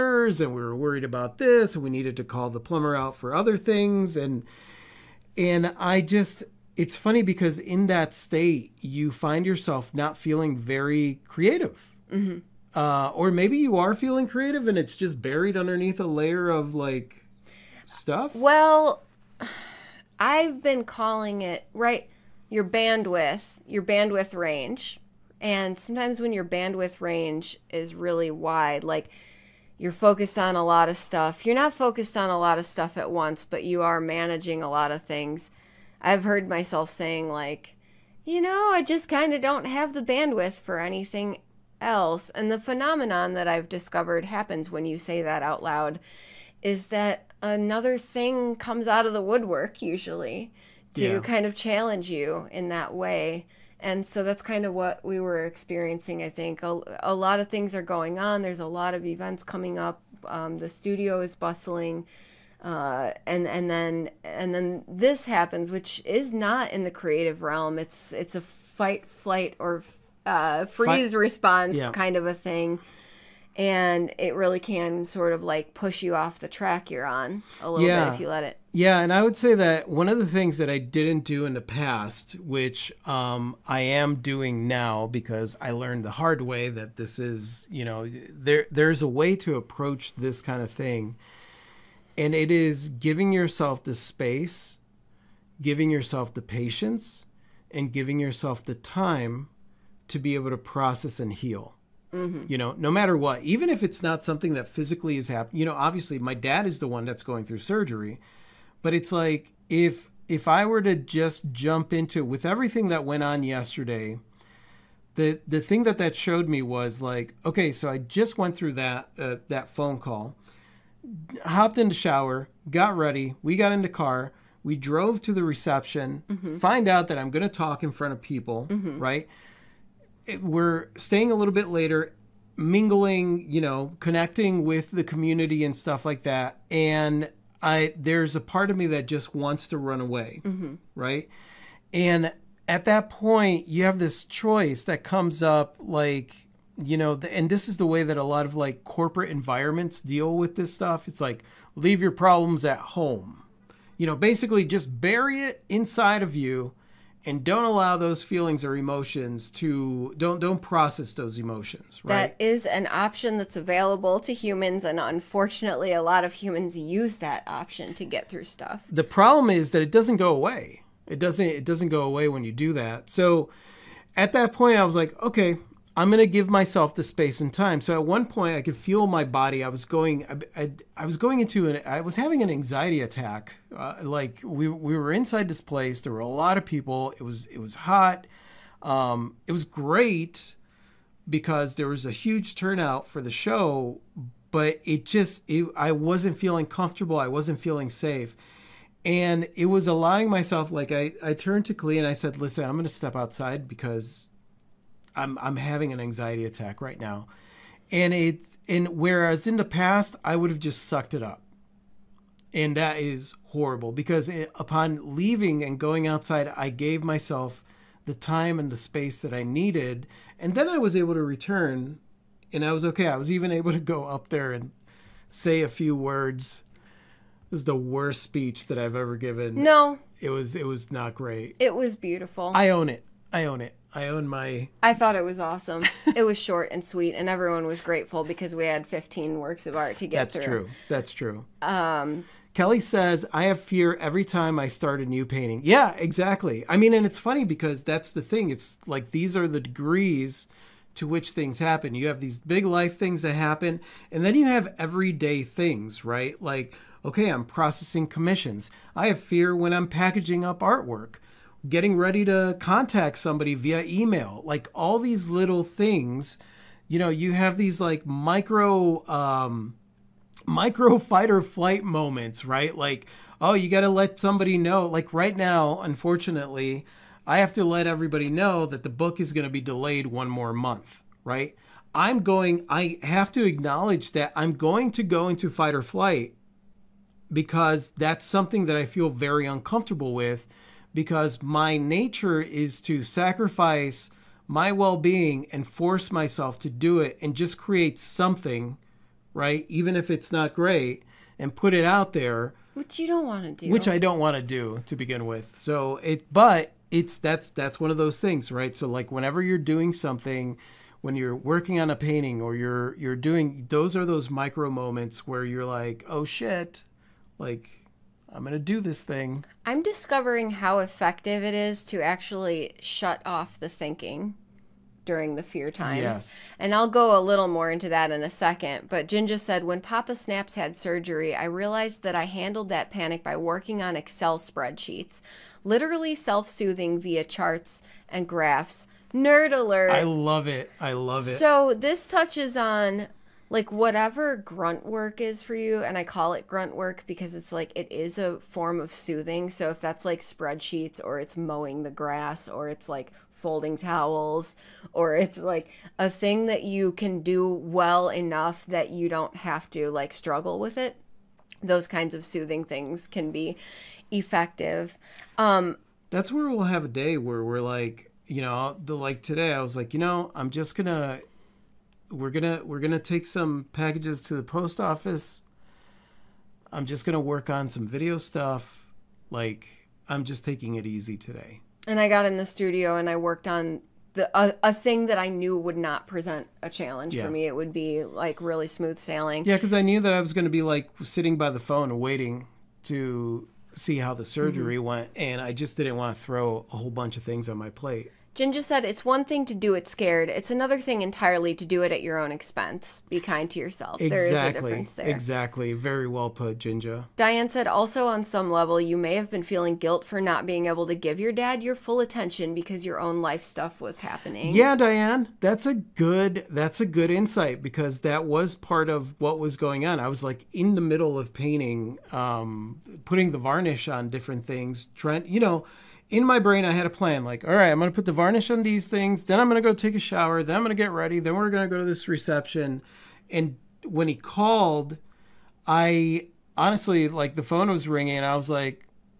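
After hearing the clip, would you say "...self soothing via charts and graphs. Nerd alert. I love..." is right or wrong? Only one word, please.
right.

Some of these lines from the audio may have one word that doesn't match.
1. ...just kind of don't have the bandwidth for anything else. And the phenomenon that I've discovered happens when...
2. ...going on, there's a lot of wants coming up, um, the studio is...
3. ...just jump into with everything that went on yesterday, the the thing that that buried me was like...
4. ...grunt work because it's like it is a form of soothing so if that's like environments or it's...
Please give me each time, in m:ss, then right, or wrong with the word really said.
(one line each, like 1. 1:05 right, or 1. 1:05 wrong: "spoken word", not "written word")
1. 0:38 right
2. 0:57 wrong: "events", not "wants"
3. 1:50 wrong: "showed", not "buried"
4. 5:46 wrong: "spreadsheets", not "environments".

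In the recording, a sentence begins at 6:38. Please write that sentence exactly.
Ginger said, It's one thing to do it scared.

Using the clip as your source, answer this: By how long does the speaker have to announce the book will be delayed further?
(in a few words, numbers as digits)
One more month.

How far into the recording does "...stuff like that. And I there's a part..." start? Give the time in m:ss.
2:15.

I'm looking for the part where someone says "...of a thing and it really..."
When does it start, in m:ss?
1:12.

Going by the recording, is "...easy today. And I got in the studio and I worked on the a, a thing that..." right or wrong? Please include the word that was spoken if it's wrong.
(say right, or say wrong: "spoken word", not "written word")
right.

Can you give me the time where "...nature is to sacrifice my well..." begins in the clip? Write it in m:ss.
4:51.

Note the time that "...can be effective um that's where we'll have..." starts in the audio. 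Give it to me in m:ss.
6:03.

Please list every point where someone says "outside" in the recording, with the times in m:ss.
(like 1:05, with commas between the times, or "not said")
3:23, 3:36.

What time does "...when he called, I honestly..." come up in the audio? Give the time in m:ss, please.
7:13.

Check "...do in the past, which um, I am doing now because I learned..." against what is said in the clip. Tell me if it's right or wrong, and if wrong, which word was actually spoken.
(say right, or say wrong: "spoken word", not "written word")
right.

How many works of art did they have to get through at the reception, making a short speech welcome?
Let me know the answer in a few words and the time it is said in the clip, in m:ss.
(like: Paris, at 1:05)
15, at 3:58.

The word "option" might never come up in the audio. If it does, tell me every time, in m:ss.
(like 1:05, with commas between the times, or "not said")
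2:42, 2:47.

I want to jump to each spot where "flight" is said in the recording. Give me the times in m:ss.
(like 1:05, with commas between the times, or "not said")
1:09, 4:31, 4:45.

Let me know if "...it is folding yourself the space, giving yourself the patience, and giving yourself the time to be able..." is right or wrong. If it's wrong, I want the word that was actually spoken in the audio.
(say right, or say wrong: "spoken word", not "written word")
wrong: "giving", not "folding".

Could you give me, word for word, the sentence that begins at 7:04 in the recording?
Trent, you know, in my brain, I had a plan.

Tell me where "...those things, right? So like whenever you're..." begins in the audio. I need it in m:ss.
5:07.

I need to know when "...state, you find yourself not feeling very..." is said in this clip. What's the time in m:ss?
0:08.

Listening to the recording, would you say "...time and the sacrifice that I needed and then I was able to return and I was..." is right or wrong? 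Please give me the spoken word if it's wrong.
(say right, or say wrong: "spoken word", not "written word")
wrong: "space", not "sacrifice".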